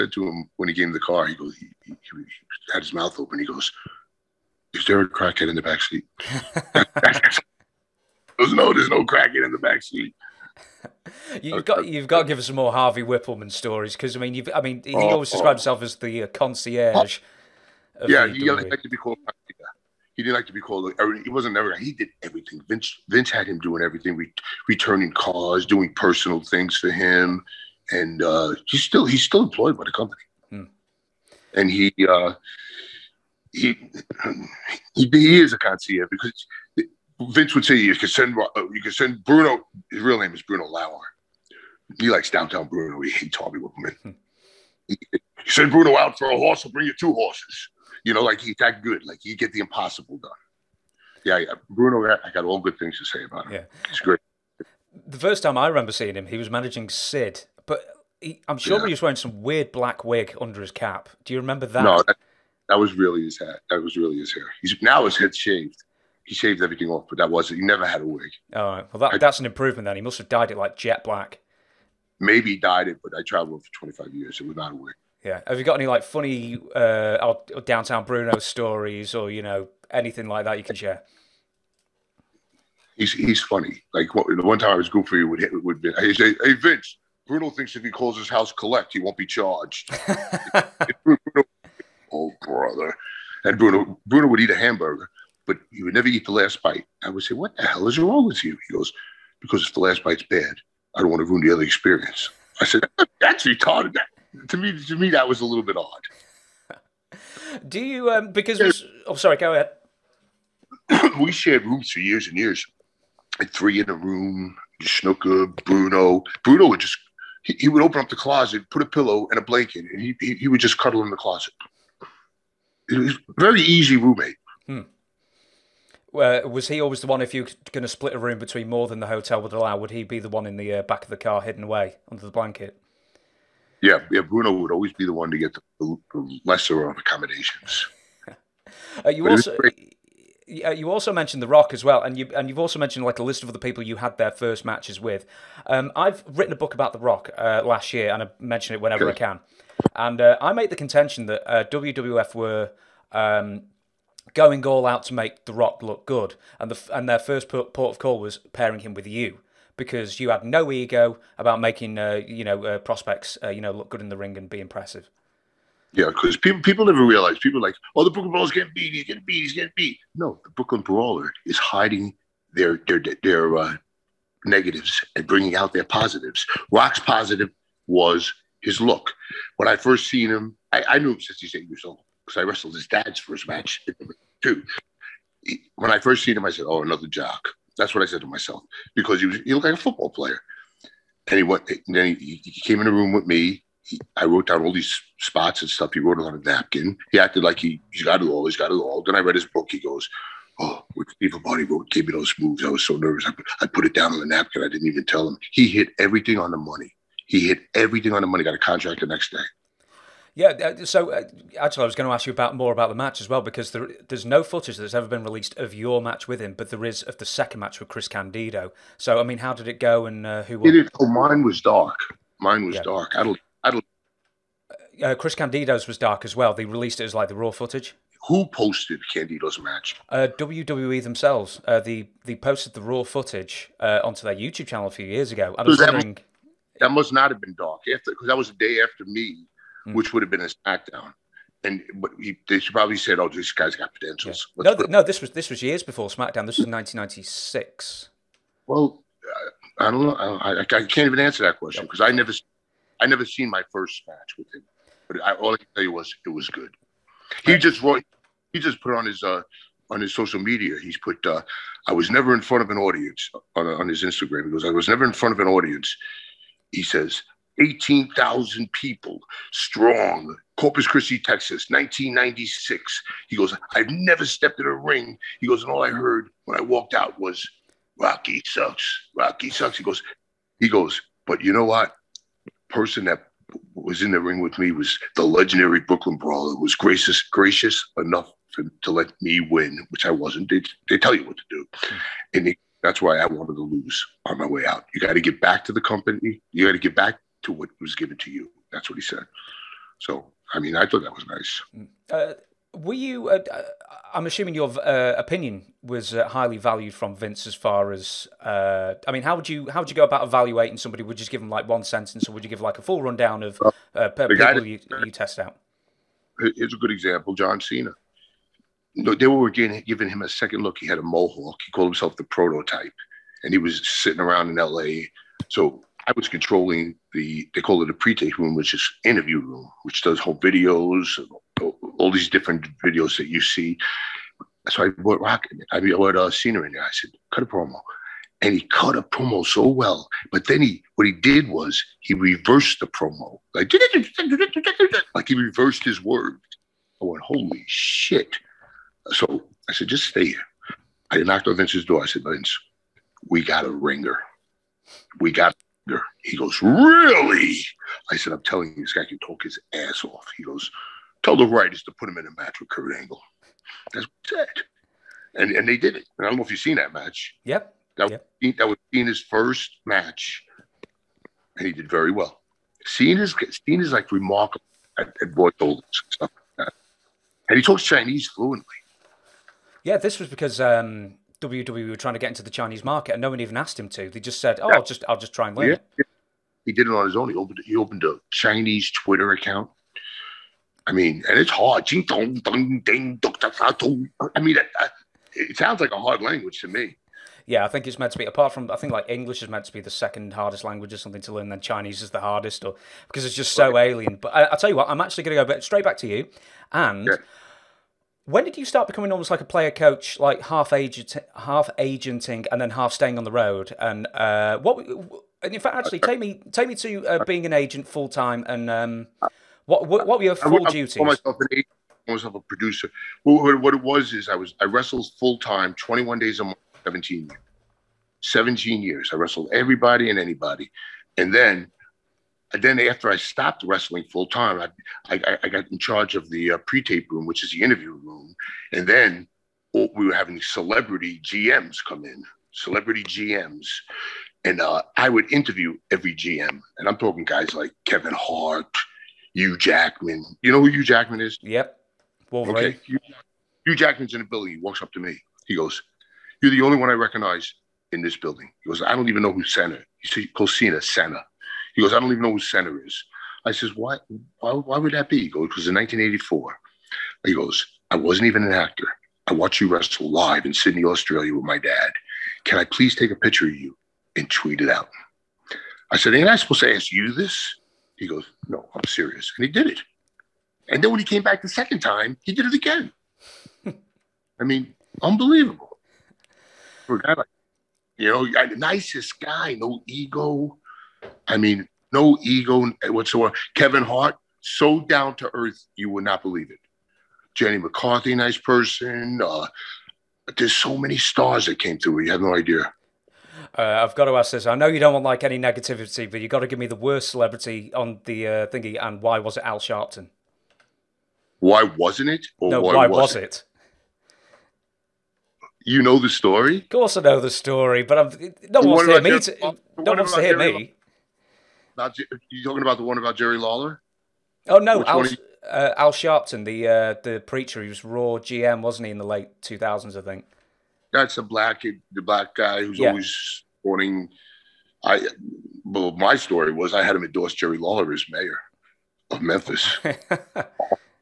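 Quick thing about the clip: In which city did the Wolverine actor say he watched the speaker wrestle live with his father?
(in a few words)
Sydney, Australia.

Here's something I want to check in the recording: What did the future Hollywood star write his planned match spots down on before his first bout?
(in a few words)
A napkin.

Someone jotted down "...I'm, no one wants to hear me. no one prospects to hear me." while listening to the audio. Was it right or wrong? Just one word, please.
wrong.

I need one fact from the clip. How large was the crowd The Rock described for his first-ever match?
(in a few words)
18,000.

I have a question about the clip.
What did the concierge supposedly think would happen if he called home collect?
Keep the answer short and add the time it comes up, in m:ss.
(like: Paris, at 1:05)
He won't be charged, at 1:28.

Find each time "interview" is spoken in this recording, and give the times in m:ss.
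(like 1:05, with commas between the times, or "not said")
5:29, 7:17, 7:25.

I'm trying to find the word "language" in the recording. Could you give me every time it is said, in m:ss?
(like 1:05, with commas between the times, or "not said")
6:36, 6:40.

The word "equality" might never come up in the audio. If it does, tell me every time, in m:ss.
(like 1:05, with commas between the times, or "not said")
not said.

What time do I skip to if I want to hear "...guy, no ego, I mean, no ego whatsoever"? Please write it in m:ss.
8:09.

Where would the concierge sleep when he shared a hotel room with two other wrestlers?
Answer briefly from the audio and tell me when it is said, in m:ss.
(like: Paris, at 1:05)
In the closet, at 2:00.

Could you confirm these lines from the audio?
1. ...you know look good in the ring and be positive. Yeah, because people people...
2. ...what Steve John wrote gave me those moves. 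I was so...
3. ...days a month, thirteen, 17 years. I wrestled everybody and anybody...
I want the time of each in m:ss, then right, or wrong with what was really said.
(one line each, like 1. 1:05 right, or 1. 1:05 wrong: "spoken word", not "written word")
1. 2:43 wrong: "impressive", not "positive"
2. 3:20 wrong: "Lombardi", not "John"
3. 7:06 wrong: "seventeen", not "thirteen".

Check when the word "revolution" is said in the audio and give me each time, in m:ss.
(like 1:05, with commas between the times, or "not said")
not said.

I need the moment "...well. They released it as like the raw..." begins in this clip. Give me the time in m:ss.
3:46.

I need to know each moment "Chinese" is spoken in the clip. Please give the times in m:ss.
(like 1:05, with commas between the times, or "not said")
6:17, 6:22, 6:28, 6:41.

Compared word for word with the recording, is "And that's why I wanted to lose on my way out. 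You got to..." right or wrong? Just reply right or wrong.
right.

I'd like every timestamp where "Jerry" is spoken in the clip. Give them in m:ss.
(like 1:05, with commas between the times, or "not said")
8:43, 8:57.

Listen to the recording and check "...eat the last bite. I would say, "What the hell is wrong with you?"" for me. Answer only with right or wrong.
right.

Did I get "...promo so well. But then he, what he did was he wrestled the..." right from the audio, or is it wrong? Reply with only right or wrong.
wrong.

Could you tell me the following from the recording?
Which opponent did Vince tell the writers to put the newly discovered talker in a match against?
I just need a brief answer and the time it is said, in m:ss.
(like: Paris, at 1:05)
Kurt Angle, at 6:02.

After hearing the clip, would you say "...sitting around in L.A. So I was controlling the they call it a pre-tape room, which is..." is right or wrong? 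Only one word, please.
right.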